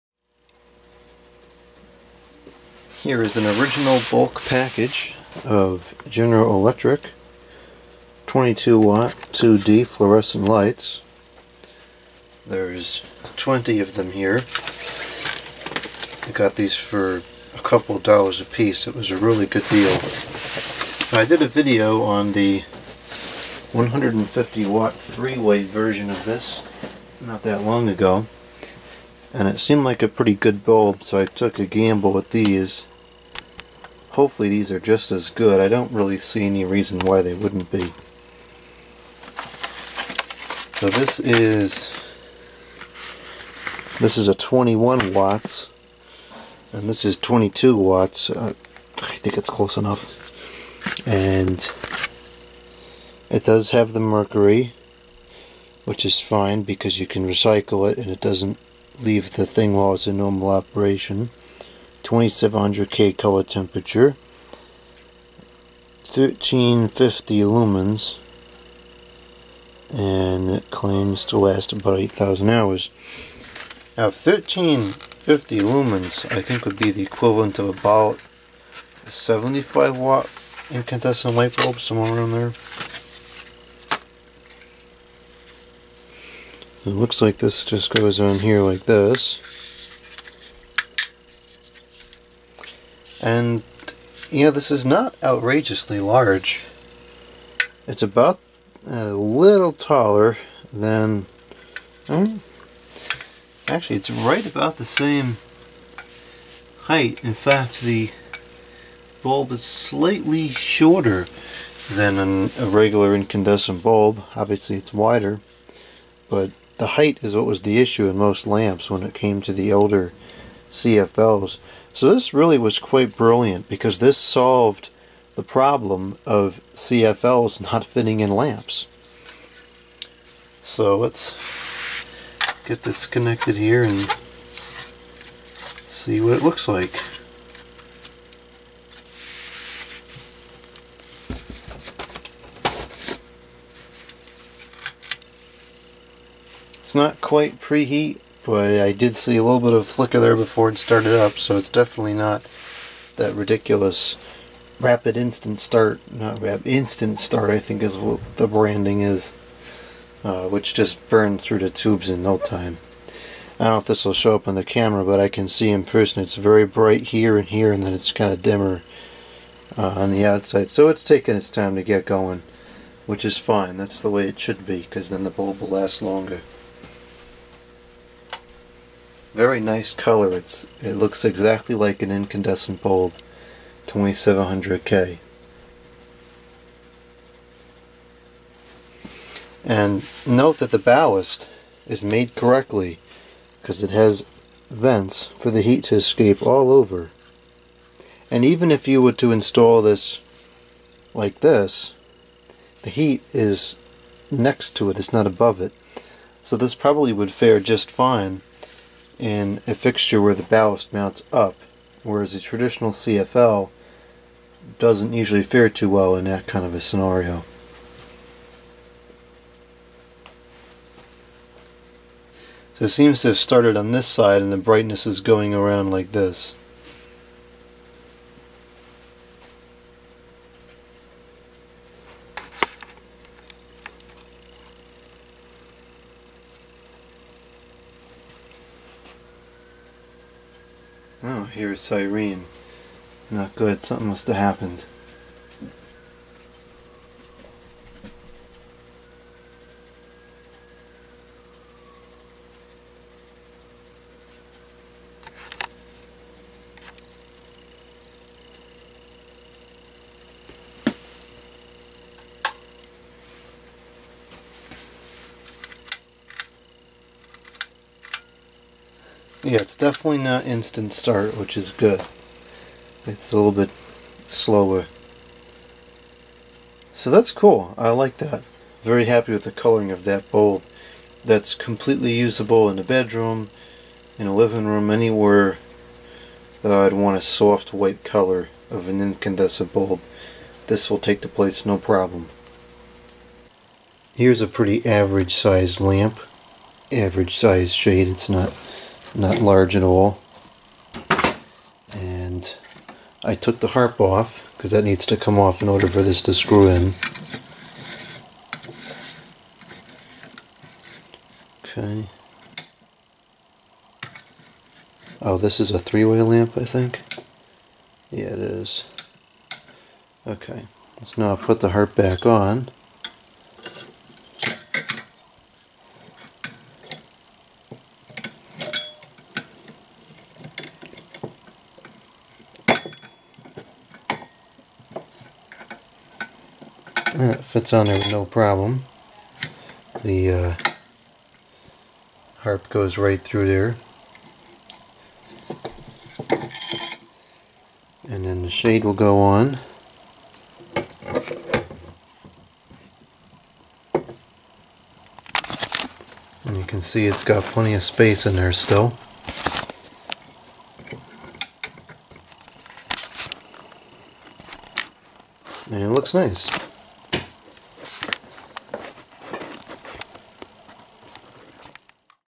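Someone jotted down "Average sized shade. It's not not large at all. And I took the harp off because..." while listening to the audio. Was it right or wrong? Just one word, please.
right.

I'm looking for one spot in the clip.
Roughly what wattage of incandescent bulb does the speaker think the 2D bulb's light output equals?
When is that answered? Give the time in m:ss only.
1:19.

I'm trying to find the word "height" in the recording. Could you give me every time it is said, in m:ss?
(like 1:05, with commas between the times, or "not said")
1:46, 1:56.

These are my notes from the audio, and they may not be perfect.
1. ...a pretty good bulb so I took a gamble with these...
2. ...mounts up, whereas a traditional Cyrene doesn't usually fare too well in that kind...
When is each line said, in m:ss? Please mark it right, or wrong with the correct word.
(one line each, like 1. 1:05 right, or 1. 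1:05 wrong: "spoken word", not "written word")
1. 0:30 right
2. 3:30 wrong: "CFL", not "Cyrene".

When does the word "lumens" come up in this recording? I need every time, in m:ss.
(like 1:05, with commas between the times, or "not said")
1:07, 1:15.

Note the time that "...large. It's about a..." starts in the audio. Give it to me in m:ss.
1:35.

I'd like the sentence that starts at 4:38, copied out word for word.
Very happy with the coloring of that bulb.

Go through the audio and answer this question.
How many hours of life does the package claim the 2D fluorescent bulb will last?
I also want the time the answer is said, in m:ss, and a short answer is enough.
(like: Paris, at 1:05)
8,000 hours, at 1:11.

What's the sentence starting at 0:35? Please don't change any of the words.
I don't really see any reason why they wouldn't be.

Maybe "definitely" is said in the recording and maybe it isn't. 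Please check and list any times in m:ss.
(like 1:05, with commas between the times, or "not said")
2:31, 4:29.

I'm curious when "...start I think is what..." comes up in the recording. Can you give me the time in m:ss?
2:37.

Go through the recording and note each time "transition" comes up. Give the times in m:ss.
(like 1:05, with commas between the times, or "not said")
not said.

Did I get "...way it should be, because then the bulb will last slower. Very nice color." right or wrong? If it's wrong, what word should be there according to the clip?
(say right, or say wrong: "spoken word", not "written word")
wrong: "longer", not "slower".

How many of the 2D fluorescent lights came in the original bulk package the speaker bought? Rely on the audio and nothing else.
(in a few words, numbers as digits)
20.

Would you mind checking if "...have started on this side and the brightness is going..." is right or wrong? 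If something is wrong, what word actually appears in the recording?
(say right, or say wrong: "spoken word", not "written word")
right.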